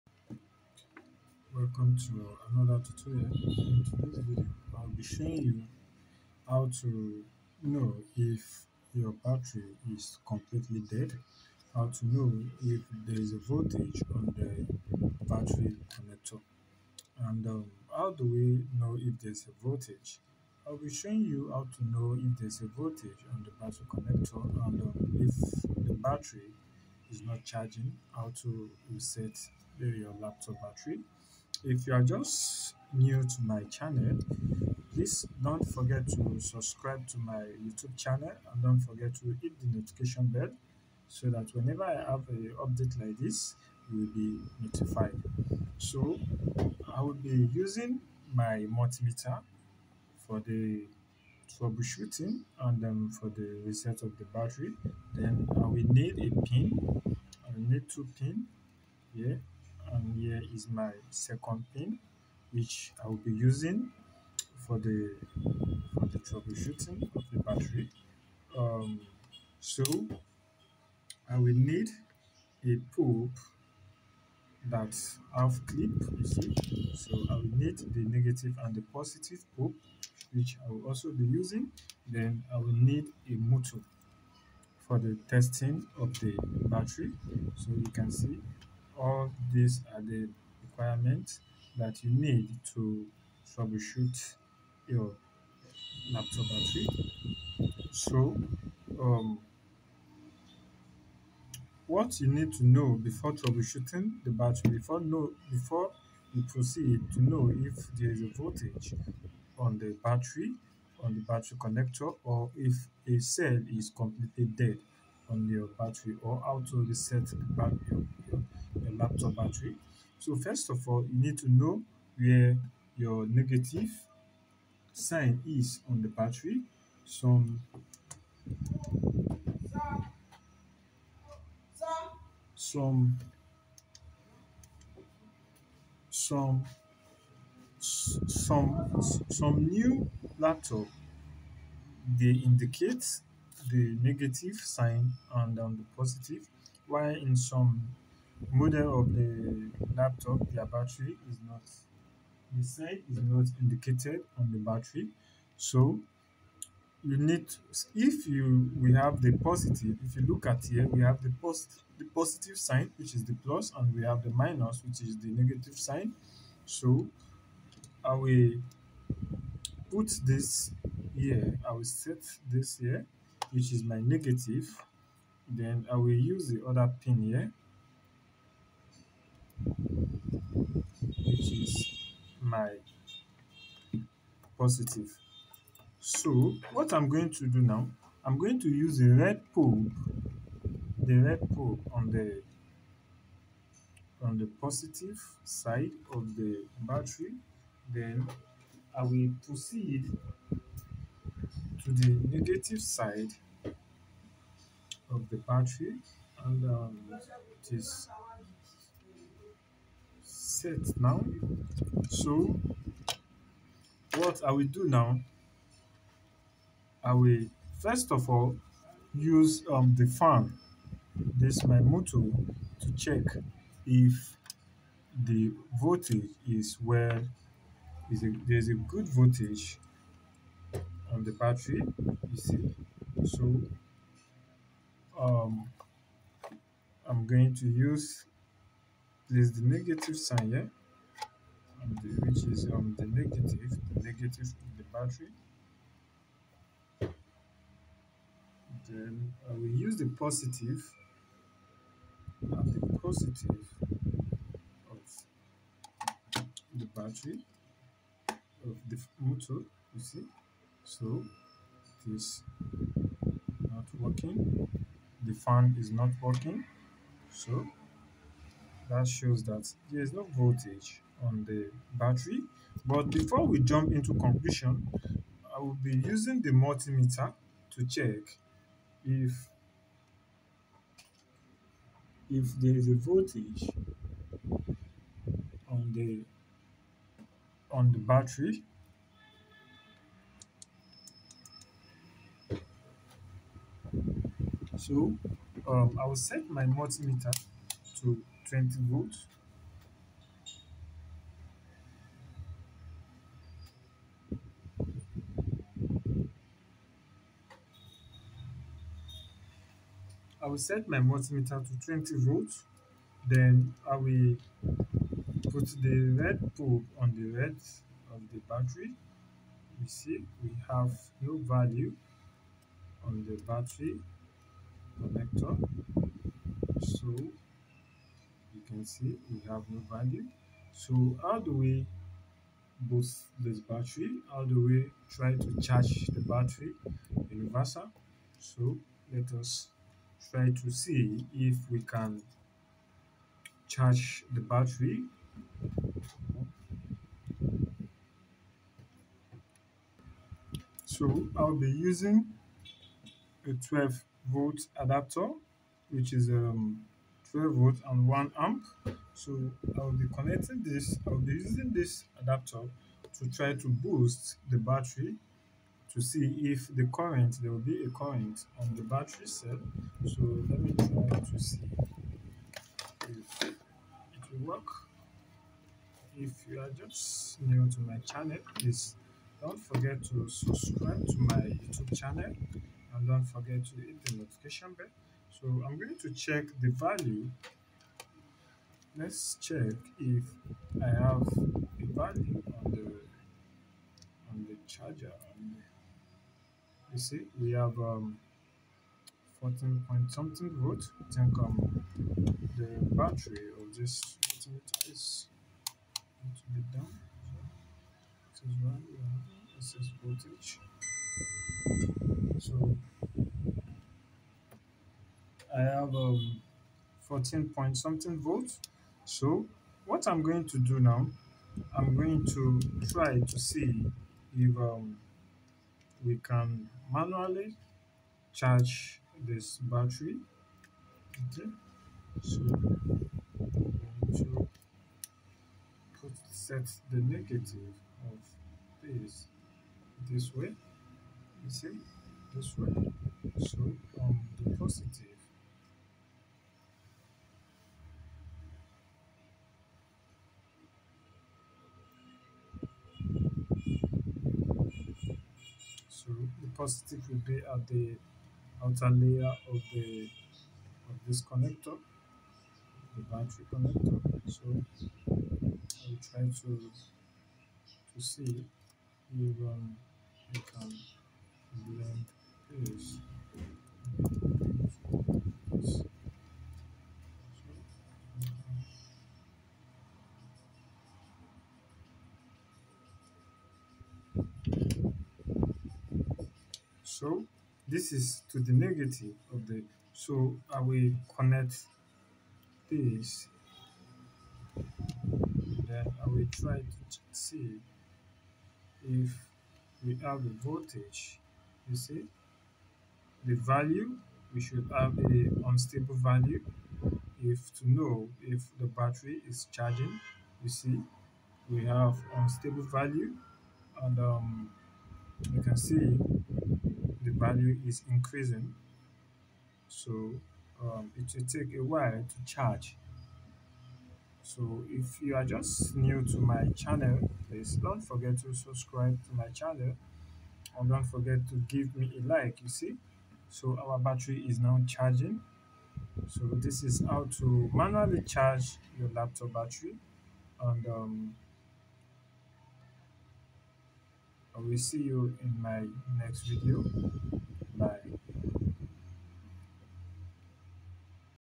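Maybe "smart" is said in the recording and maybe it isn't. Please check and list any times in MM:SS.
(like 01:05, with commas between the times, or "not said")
not said.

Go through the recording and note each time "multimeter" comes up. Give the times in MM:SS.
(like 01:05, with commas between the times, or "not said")
00:48, 04:36, 04:56, 05:10.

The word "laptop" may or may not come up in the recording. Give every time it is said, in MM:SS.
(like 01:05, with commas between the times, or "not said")
00:30, 01:36, 01:59, 02:20, 02:29, 08:58.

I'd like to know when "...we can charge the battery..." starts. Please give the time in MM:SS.
05:41.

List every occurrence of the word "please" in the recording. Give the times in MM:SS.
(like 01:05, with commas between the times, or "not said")
00:34, 06:18, 08:47.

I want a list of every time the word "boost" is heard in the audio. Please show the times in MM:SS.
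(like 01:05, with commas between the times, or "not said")
05:32, 06:03.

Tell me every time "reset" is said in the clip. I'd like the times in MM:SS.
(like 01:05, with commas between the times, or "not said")
00:28, 00:53, 01:56.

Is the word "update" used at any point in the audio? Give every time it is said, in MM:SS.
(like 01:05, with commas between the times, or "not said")
00:42.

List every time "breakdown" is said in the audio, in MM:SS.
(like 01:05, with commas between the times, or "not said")
not said.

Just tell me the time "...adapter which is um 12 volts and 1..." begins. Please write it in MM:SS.
05:54.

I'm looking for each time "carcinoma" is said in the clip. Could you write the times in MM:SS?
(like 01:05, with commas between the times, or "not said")
not said.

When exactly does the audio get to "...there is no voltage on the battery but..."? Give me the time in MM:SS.
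04:29.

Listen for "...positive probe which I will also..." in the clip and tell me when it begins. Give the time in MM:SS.
01:18.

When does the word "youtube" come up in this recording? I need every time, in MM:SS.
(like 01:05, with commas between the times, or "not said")
00:37, 06:21.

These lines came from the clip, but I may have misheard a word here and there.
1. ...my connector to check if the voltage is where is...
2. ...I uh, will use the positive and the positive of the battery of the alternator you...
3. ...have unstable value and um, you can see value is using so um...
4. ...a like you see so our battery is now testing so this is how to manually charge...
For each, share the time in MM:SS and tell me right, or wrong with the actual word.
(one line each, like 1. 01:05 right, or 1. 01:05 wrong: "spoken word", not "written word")
1. 03:41 wrong: "motor", not "connector"
2. 04:09 wrong: "motor", not "alternator"
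3. 08:31 wrong: "increasing", not "using"
4. 08:51 wrong: "charging", not "testing".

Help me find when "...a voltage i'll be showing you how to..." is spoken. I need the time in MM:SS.
00:19.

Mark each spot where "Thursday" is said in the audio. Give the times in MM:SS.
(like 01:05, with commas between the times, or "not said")
not said.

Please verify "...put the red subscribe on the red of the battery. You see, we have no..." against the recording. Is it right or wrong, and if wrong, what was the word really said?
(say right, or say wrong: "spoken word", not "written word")
wrong: "probe", not "subscribe".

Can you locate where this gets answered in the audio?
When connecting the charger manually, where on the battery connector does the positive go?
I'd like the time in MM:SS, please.
07:38.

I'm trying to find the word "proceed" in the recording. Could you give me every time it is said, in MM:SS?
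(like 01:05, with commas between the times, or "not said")
01:46, 03:19.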